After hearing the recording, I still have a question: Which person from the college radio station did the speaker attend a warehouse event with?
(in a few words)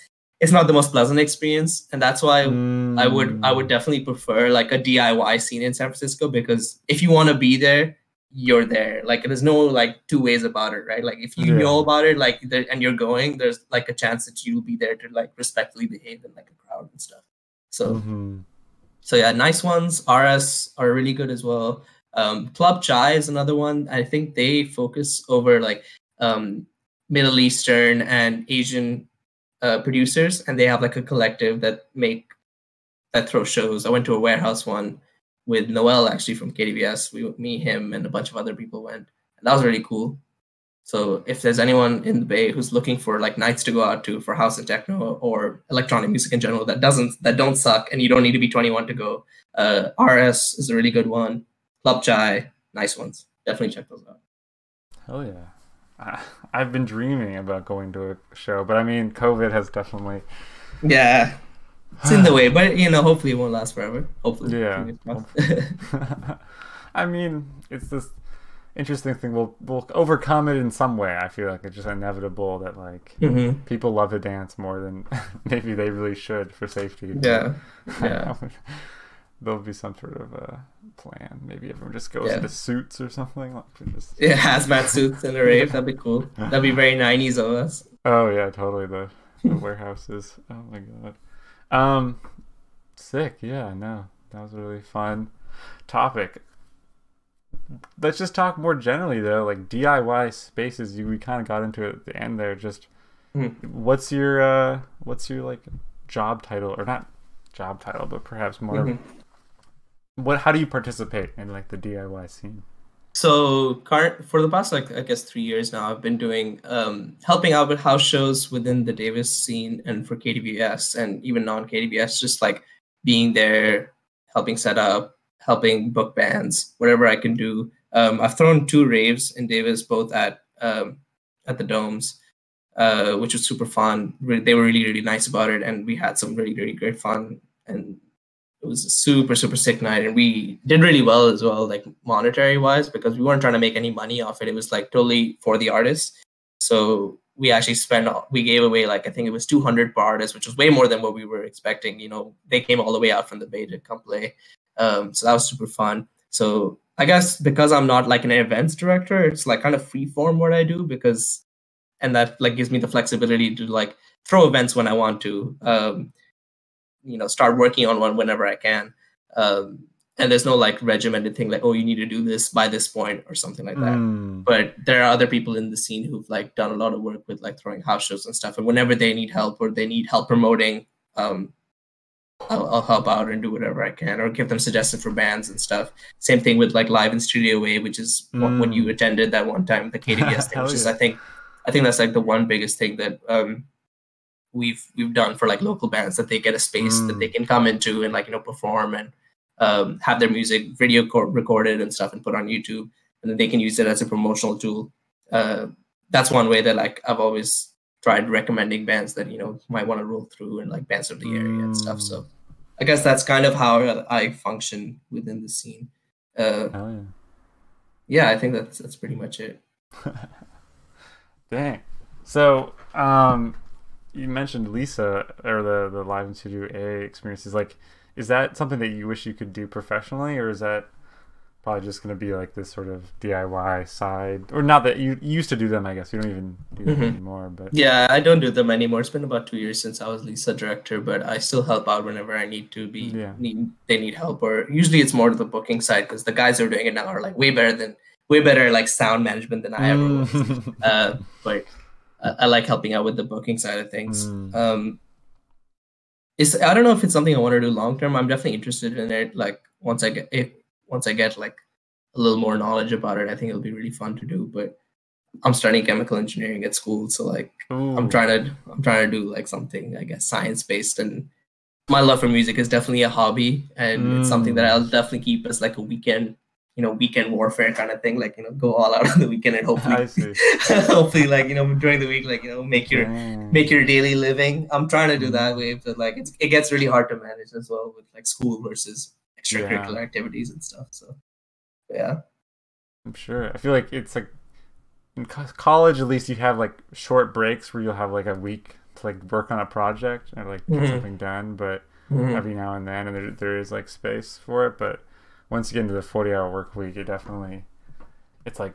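Noel.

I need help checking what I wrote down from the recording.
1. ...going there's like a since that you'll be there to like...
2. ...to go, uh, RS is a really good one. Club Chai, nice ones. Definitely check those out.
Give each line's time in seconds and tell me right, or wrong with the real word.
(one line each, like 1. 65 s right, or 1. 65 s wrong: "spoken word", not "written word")
1. 12 s wrong: "chance", not "since"
2. 48 s right.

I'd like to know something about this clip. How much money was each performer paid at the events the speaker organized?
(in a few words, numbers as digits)
200.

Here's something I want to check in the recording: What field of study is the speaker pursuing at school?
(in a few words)
chemical engineering.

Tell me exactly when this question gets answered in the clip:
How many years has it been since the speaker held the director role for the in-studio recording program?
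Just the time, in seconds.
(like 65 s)
239 s.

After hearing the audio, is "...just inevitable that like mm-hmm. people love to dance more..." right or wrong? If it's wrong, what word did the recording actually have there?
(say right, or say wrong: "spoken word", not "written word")
right.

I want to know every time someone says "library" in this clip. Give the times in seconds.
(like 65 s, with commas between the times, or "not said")
not said.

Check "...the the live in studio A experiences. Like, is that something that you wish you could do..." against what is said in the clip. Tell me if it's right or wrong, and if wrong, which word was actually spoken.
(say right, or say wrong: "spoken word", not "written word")
right.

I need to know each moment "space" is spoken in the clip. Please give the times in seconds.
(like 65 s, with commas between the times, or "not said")
100 s, 196 s, 303 s.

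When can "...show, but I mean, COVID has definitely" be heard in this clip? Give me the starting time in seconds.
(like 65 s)
58 s.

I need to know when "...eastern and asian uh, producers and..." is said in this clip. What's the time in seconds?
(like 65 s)
27 s.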